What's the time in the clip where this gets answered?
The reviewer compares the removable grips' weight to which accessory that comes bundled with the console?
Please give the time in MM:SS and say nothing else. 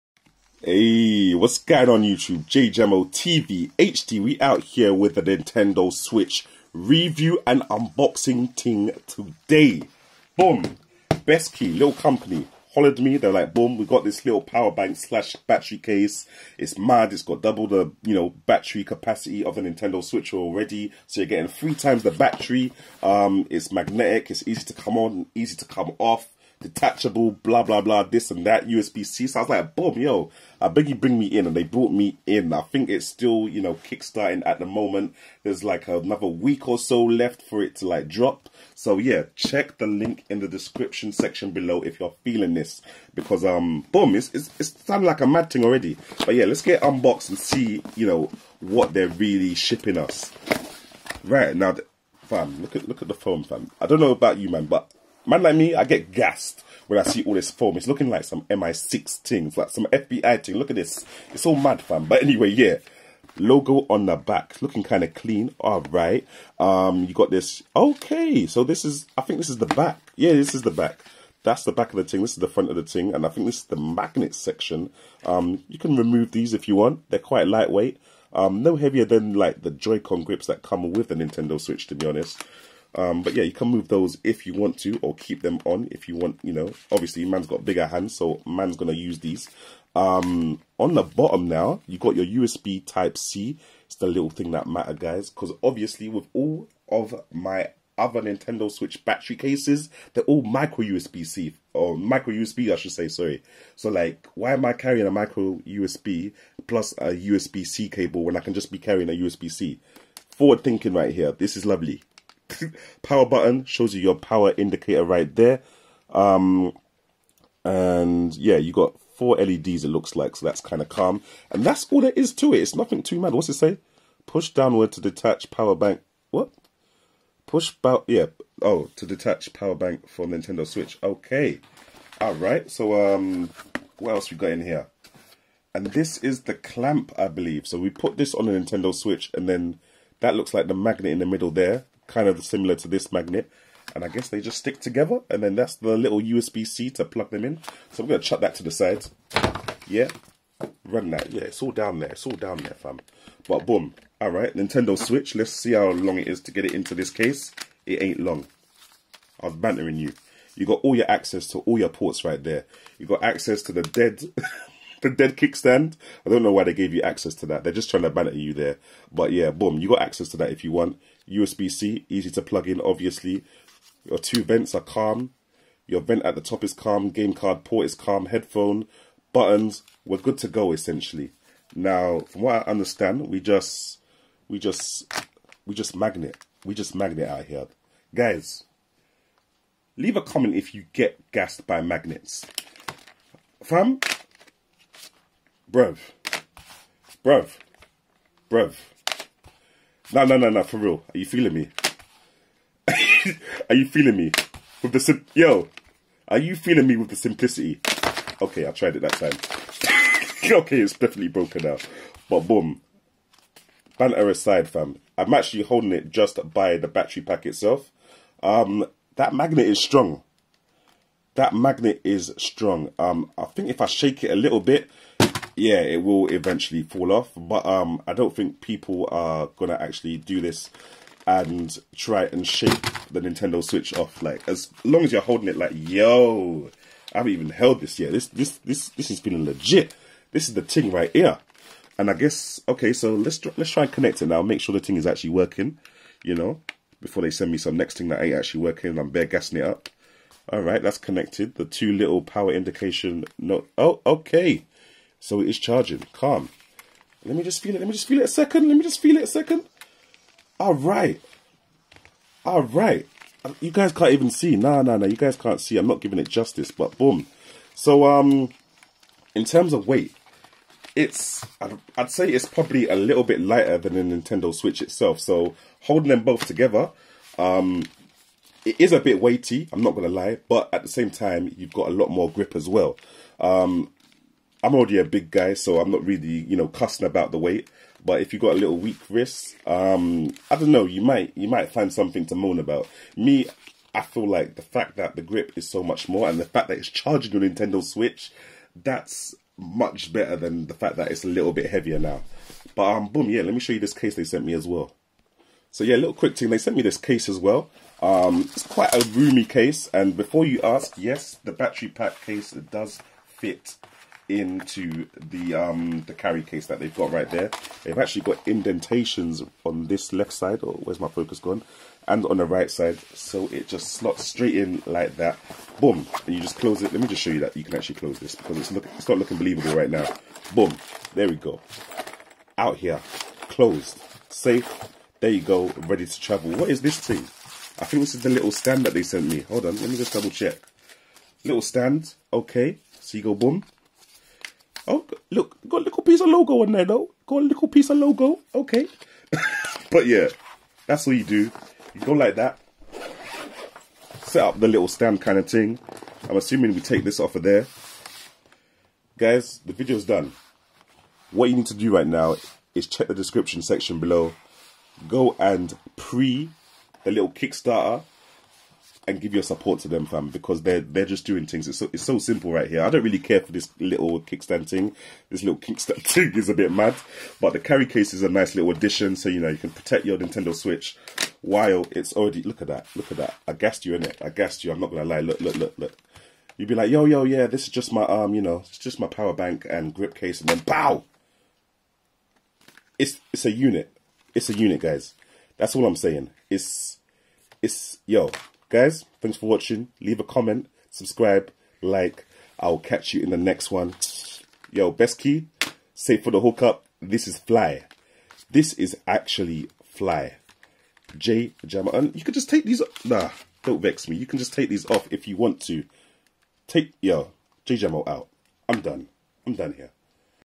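01:19.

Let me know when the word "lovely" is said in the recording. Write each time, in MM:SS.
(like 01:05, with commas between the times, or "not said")
01:51.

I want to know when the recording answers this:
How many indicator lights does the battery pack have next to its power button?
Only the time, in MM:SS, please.
01:59.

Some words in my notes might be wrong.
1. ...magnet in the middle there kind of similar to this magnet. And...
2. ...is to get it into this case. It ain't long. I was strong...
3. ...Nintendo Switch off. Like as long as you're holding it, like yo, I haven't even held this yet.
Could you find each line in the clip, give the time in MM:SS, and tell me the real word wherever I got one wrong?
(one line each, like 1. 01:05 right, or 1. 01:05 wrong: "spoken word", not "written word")
1. 02:20 right
2. 02:36 wrong: "bantering", not "strong"
3. 03:53 right.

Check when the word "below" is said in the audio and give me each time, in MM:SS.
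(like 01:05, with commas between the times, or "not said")
00:41, 06:03.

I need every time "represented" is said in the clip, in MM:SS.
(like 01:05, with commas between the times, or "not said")
not said.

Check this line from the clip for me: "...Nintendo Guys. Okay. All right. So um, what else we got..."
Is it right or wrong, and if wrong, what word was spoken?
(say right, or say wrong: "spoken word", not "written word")
wrong: "Switch", not "Guys".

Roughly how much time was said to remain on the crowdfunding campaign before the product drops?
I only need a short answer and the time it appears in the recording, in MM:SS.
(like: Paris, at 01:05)
another week, at 00:35.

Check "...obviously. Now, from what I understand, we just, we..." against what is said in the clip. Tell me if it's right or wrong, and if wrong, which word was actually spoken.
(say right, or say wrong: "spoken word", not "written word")
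wrong: "essentially", not "obviously".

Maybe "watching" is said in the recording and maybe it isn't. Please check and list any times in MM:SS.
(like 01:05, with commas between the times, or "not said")
06:39.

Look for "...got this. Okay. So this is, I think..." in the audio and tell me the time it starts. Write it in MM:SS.
01:07.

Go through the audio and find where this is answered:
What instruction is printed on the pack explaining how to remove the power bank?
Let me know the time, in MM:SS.
02:04.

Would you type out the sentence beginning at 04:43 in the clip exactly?
Um, I'm already a big guy, so I'm not really, you know, cussing about the weight.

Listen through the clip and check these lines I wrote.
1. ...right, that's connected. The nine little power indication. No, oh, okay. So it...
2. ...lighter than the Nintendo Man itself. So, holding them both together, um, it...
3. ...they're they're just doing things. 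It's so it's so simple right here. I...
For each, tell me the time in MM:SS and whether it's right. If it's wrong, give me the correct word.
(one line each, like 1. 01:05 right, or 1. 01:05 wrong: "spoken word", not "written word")
1. 04:10 wrong: "two", not "nine"
2. 04:33 wrong: "Switch", not "Man"
3. 06:10 right.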